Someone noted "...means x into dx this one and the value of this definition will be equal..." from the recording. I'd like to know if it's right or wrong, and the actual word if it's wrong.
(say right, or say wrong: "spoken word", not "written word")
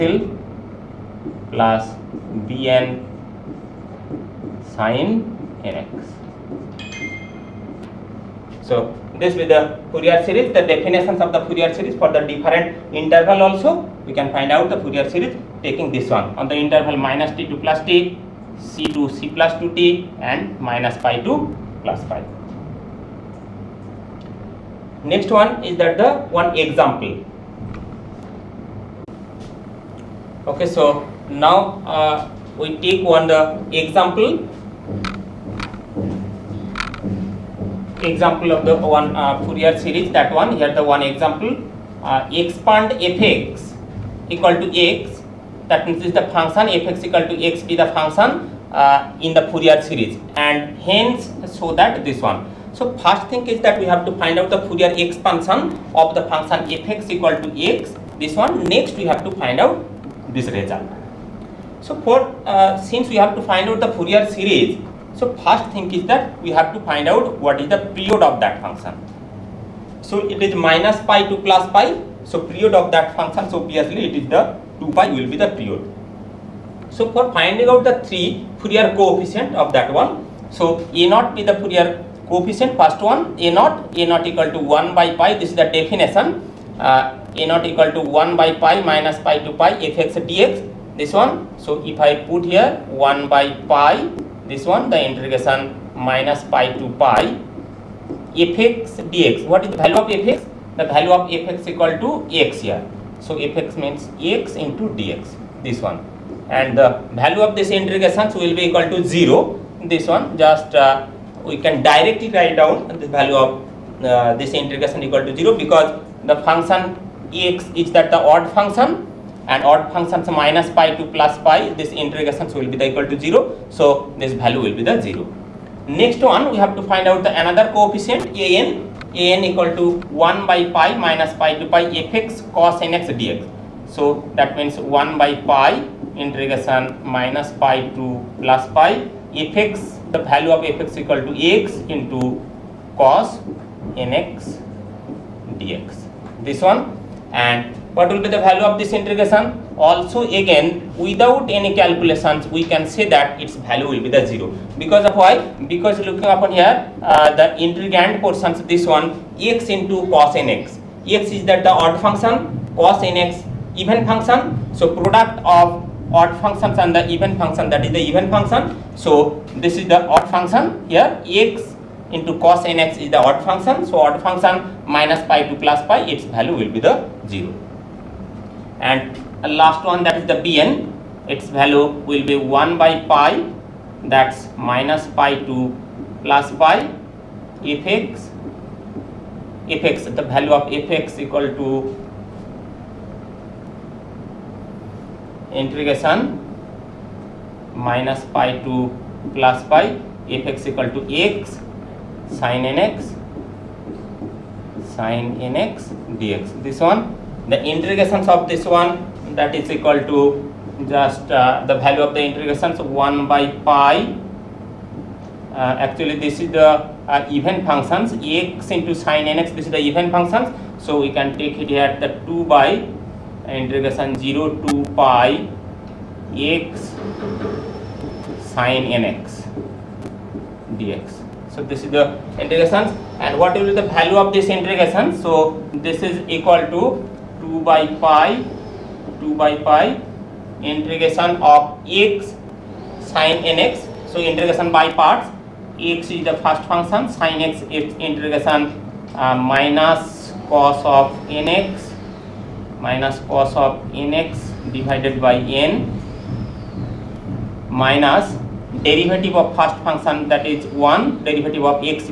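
wrong: "integration", not "definition".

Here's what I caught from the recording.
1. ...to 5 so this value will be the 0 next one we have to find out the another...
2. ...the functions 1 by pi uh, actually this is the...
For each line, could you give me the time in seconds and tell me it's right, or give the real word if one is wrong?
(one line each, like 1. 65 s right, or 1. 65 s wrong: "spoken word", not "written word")
1. 123 s wrong: "0", not "5"
2. 212 s wrong: "integrations", not "functions".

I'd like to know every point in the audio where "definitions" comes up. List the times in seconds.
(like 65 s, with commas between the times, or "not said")
10 s, 85 s.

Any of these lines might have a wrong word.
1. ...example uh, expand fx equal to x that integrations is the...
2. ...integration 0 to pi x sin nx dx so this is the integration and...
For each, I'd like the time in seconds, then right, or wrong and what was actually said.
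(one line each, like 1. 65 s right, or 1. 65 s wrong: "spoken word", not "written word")
1. 41 s wrong: "means", not "integrations"
2. 223 s right.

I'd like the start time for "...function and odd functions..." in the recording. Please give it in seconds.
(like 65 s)
118 s.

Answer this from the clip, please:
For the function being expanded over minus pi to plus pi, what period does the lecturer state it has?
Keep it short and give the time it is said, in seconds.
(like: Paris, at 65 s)
2 pi, at 74 s.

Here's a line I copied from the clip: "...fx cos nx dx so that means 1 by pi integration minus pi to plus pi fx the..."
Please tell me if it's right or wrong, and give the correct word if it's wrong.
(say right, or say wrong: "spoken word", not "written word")
right.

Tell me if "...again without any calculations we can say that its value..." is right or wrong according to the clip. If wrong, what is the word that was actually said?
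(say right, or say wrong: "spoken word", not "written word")
right.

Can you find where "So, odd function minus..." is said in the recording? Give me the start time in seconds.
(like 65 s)
173 s.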